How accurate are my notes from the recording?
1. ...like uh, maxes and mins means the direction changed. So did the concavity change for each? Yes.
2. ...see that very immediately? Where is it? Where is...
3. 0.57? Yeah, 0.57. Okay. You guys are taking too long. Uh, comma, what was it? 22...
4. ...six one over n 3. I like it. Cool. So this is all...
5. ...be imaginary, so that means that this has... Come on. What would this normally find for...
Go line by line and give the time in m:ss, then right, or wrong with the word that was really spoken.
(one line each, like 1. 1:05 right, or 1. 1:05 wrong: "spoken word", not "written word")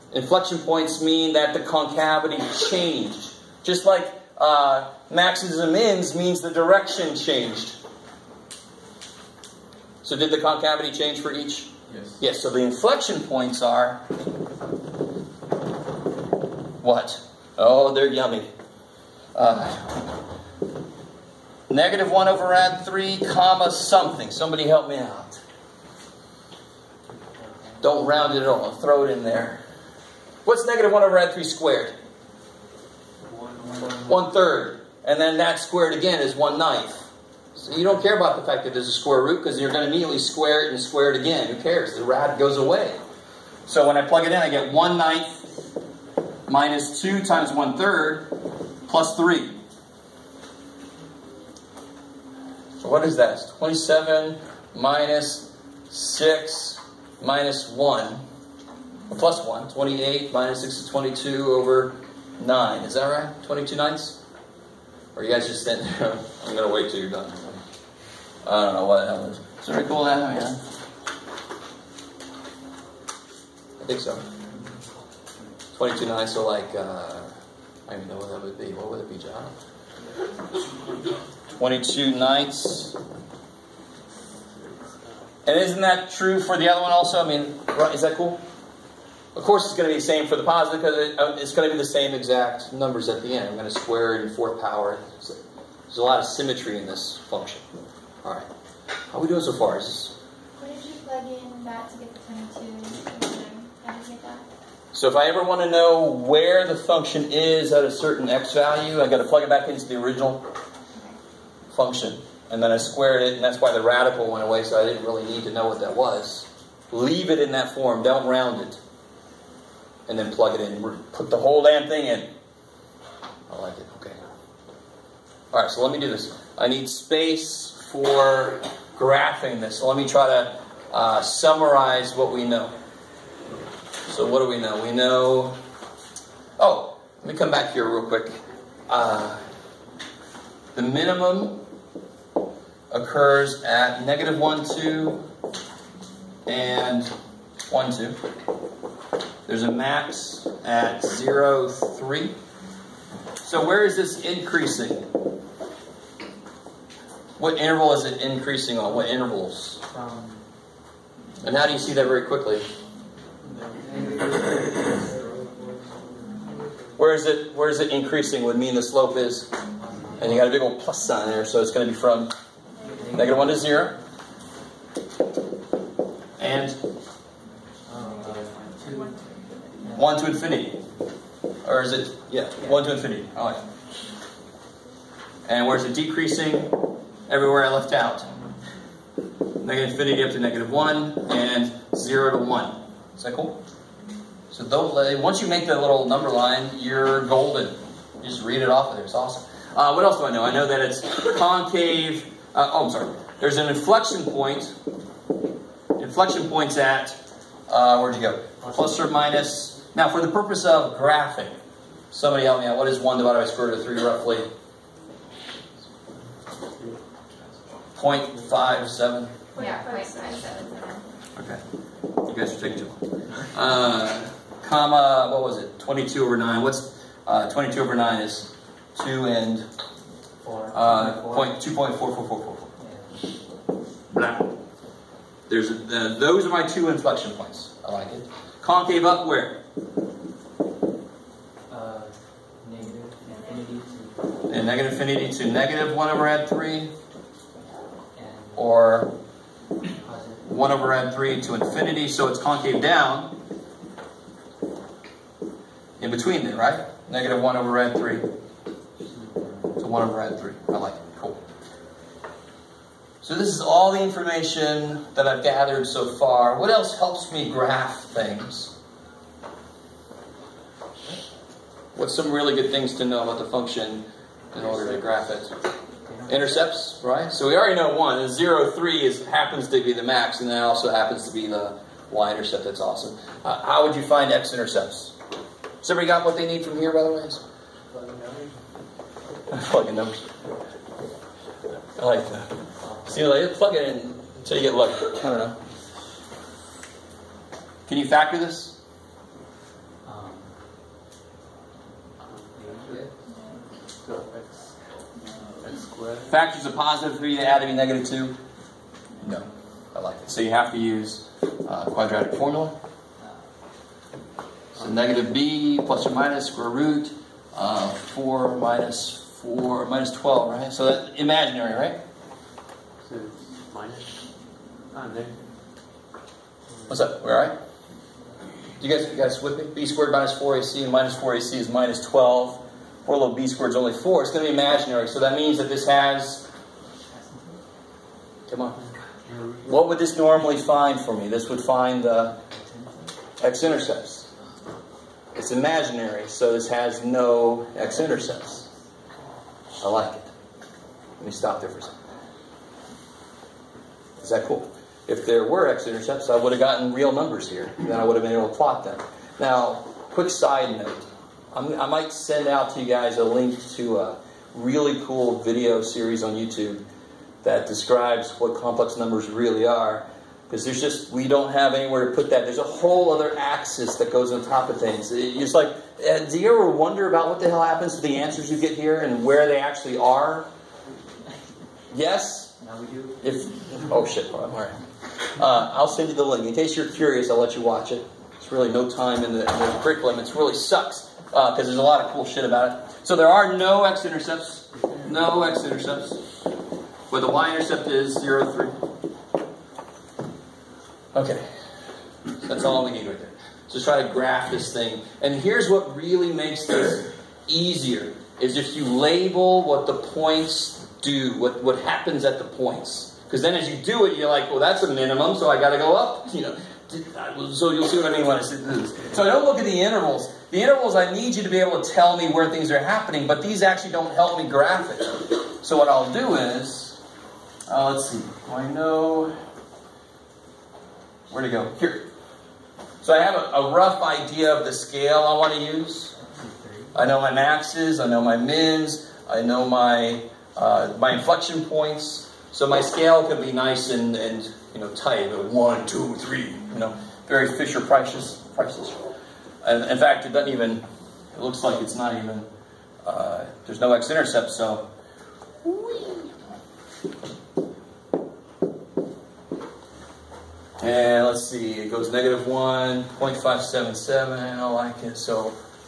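1. 0:03 right
2. 2:41 wrong: "quickly", not "immediately"
3. 3:37 right
4. 4:17 wrong: "three", not "six"
5. 5:34 right.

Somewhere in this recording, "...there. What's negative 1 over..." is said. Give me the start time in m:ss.
0:29.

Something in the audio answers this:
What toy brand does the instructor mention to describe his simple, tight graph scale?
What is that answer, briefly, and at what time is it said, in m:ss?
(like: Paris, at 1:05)
Fisher Price, at 7:27.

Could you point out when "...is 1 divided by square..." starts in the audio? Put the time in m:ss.
3:32.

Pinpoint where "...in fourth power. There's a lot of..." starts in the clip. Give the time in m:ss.
1:34.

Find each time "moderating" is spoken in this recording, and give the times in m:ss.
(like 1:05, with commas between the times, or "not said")
not said.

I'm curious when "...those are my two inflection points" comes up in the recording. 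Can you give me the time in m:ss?
3:56.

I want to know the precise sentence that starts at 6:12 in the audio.
There's a whole other axis that goes on top of things.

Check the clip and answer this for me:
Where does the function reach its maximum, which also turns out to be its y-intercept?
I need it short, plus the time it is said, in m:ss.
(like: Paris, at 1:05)
(0, 3), at 2:31.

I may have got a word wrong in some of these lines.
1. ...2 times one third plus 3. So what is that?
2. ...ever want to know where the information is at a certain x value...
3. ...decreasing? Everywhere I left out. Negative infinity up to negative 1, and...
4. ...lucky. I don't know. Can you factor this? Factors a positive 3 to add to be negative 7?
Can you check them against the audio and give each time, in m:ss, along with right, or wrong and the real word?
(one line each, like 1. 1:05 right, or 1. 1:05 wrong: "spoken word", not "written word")
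1. 0:47 right
2. 1:45 wrong: "function", not "information"
3. 3:05 right
4. 4:54 wrong: "2", not "7".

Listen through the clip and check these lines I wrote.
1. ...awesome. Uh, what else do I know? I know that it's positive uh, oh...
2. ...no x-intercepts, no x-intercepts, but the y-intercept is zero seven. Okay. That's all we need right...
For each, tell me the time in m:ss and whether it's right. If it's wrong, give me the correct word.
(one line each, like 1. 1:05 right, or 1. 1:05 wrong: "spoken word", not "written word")
1. 3:19 wrong: "concave", not "positive"
2. 6:33 wrong: "three", not "seven".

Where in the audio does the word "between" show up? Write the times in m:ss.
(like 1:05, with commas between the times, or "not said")
4:16.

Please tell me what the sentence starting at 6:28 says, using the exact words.
It's really no time in the, in the curriculum.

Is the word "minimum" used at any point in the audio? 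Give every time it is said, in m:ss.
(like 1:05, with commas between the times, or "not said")
2:20, 6:54.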